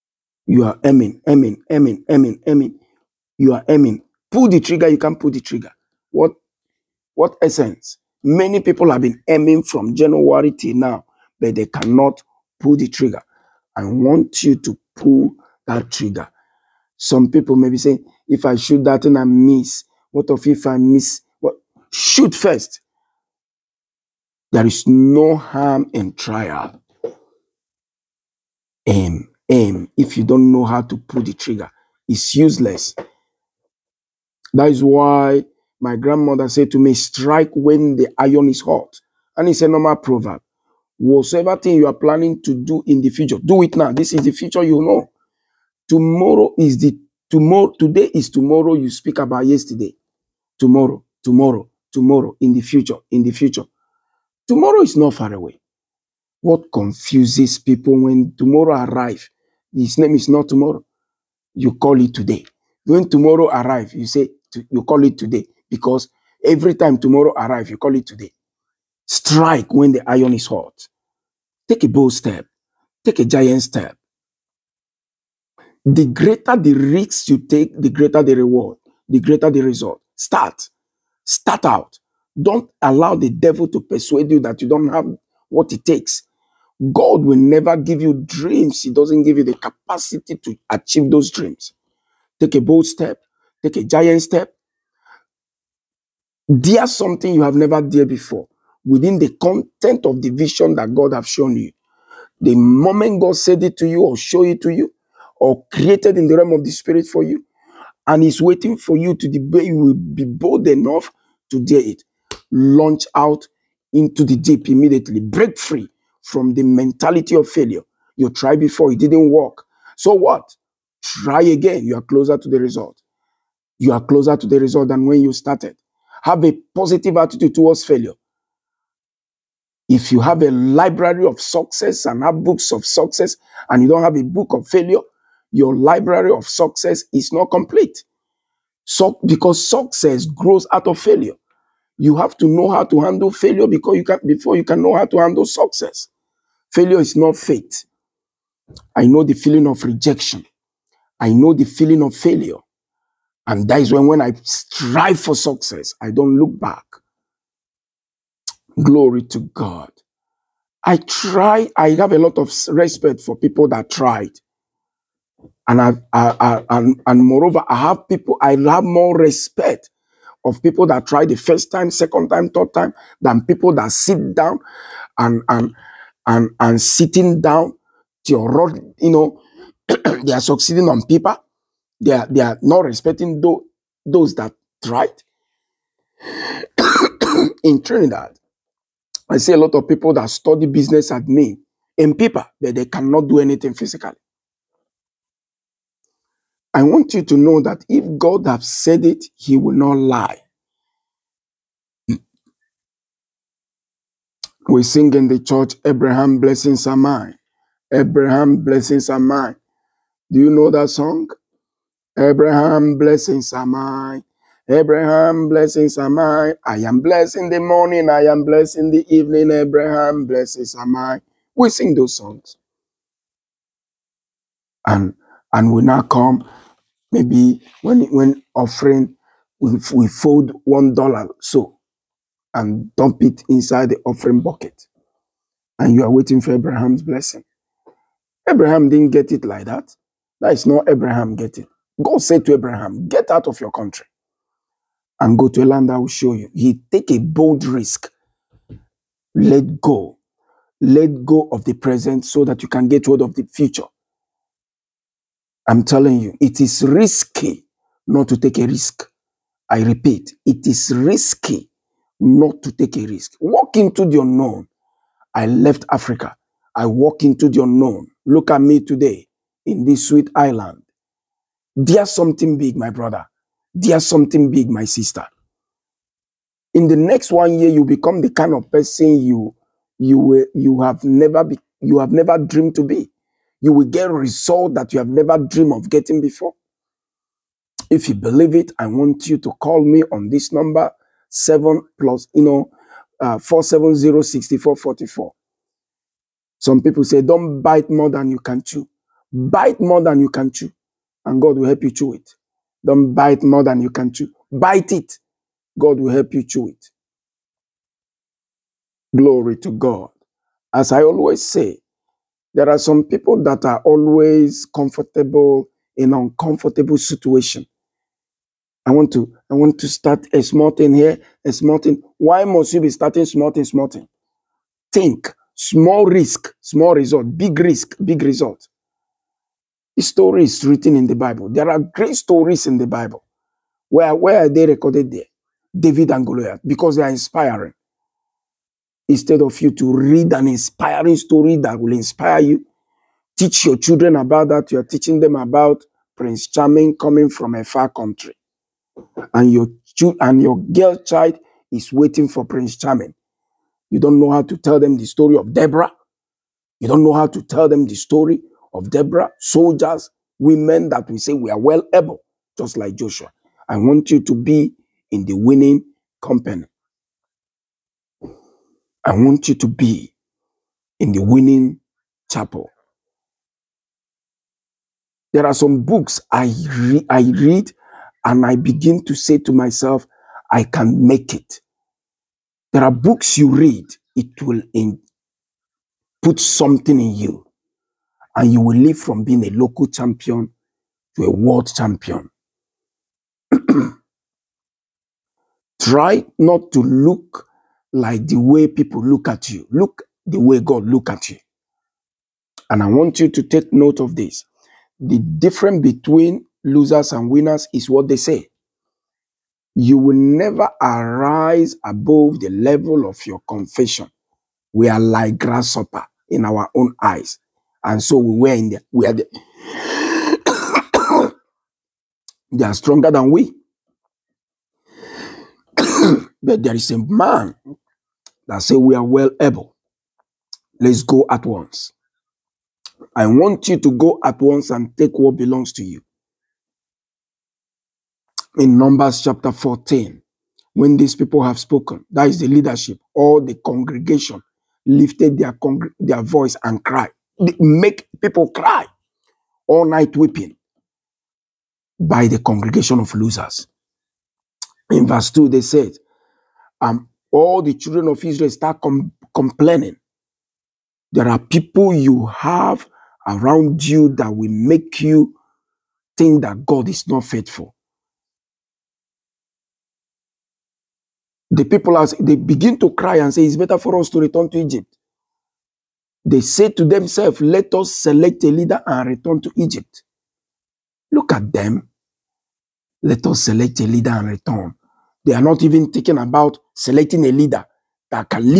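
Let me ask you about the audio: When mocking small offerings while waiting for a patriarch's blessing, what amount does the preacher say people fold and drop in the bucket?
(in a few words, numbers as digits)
1 dollar.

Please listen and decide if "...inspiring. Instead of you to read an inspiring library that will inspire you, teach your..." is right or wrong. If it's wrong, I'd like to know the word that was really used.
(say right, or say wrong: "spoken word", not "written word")
wrong: "story", not "library".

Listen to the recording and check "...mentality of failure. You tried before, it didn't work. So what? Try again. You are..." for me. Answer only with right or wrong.
right.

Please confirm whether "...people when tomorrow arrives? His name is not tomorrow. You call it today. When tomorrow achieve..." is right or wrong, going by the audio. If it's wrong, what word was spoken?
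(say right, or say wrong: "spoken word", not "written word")
wrong: "arrive", not "achieve".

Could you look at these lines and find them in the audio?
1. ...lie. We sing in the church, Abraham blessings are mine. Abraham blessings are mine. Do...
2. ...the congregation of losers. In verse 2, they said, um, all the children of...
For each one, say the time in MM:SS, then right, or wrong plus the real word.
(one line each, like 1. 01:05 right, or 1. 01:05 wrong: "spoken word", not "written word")
1. 03:19 right
2. 07:32 right.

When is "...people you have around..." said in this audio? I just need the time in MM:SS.
07:41.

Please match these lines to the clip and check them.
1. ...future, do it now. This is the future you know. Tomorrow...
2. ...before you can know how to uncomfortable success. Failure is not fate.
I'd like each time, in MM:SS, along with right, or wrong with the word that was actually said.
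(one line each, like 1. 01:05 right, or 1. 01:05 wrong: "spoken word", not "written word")
1. 00:43 right
2. 02:24 wrong: "handle", not "uncomfortable".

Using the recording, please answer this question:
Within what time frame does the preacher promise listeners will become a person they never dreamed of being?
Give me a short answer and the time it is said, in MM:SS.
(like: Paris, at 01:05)
1 year, at 04:37.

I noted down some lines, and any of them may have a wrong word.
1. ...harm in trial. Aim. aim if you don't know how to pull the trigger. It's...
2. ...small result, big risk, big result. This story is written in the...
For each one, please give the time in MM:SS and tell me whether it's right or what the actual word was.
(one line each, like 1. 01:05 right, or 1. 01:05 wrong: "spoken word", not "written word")
1. 00:25 right
2. 05:26 right.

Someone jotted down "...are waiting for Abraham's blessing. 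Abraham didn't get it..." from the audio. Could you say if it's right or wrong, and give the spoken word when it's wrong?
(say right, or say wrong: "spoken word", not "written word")
right.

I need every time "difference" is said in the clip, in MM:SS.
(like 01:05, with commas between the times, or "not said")
06:45.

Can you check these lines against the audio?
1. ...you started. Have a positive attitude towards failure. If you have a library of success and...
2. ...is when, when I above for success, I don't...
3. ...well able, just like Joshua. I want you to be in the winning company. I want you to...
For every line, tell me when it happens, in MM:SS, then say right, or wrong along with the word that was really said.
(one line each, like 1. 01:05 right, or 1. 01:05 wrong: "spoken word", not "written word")
1. 02:05 right
2. 02:33 wrong: "strive", not "above"
3. 06:01 right.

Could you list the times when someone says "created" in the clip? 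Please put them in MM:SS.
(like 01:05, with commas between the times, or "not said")
01:45.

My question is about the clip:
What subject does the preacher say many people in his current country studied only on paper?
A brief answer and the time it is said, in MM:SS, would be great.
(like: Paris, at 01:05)
Business admin, at 03:10.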